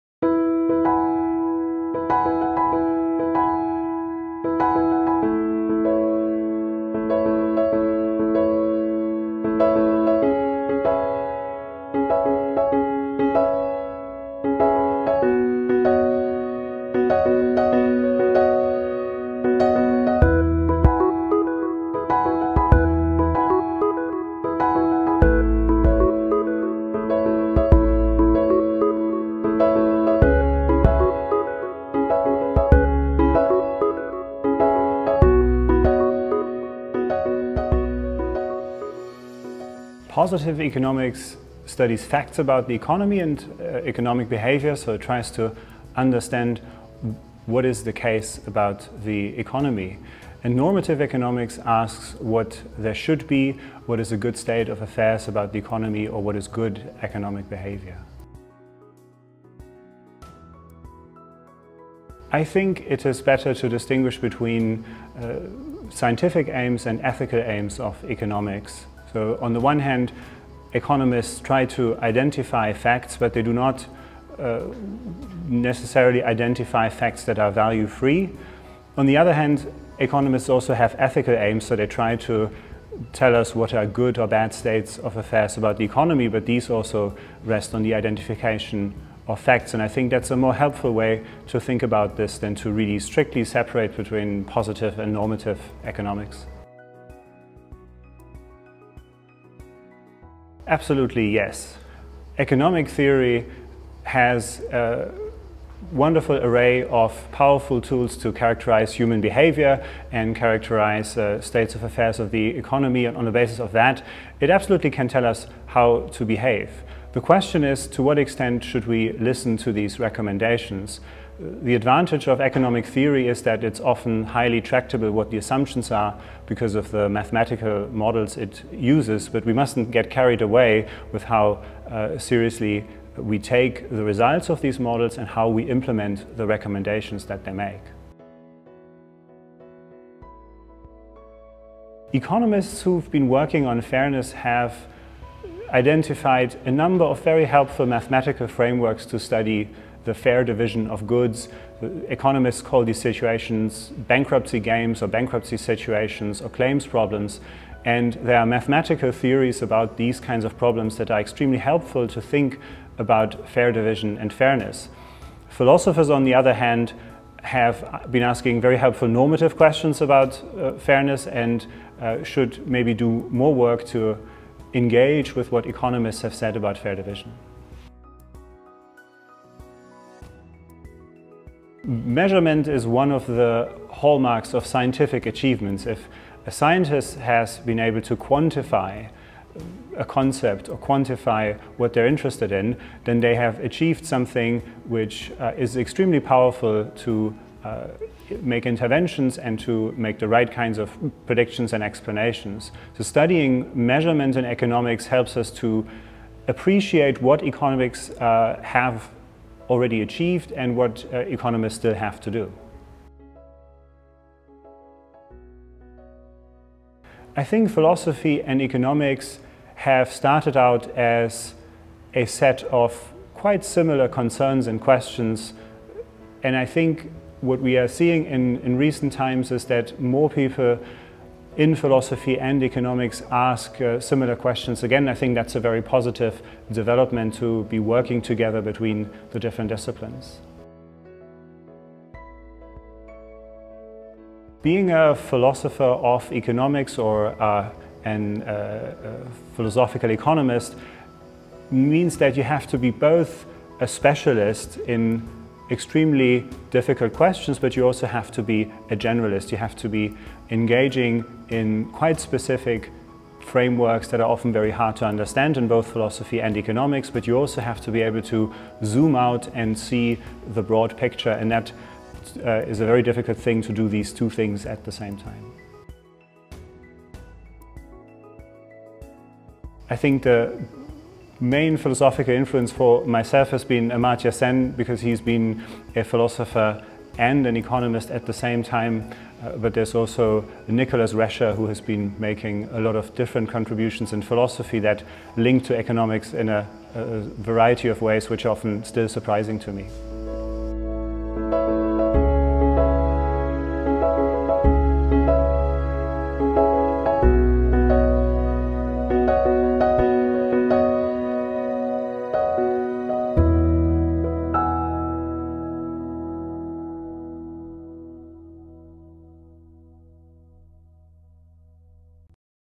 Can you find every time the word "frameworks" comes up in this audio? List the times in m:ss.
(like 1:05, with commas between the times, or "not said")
2:28, 4:23.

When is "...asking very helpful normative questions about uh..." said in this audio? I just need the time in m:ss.
2:48.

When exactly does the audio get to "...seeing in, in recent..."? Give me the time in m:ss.
3:47.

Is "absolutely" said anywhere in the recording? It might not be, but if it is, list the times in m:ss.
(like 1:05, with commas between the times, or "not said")
1:40, 1:54.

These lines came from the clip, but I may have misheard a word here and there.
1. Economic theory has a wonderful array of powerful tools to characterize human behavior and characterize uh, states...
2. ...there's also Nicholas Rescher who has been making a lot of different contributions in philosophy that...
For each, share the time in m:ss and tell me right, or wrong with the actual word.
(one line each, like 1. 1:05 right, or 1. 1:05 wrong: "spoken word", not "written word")
1. 1:42 right
2. 4:49 right.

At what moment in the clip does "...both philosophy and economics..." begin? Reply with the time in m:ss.
4:25.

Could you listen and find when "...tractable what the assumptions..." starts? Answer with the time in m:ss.
2:04.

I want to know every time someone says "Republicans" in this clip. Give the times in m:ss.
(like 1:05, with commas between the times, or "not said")
not said.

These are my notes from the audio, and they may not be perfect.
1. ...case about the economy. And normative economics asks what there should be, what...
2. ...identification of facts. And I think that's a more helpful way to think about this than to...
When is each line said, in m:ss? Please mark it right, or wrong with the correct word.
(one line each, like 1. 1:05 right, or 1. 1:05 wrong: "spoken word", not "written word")
1. 0:48 right
2. 1:27 right.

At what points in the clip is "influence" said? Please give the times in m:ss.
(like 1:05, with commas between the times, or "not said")
4:42.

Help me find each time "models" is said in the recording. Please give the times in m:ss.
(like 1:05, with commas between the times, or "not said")
2:07, 2:14.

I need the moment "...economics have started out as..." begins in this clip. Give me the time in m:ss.
3:38.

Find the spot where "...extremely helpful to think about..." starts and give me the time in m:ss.
2:41.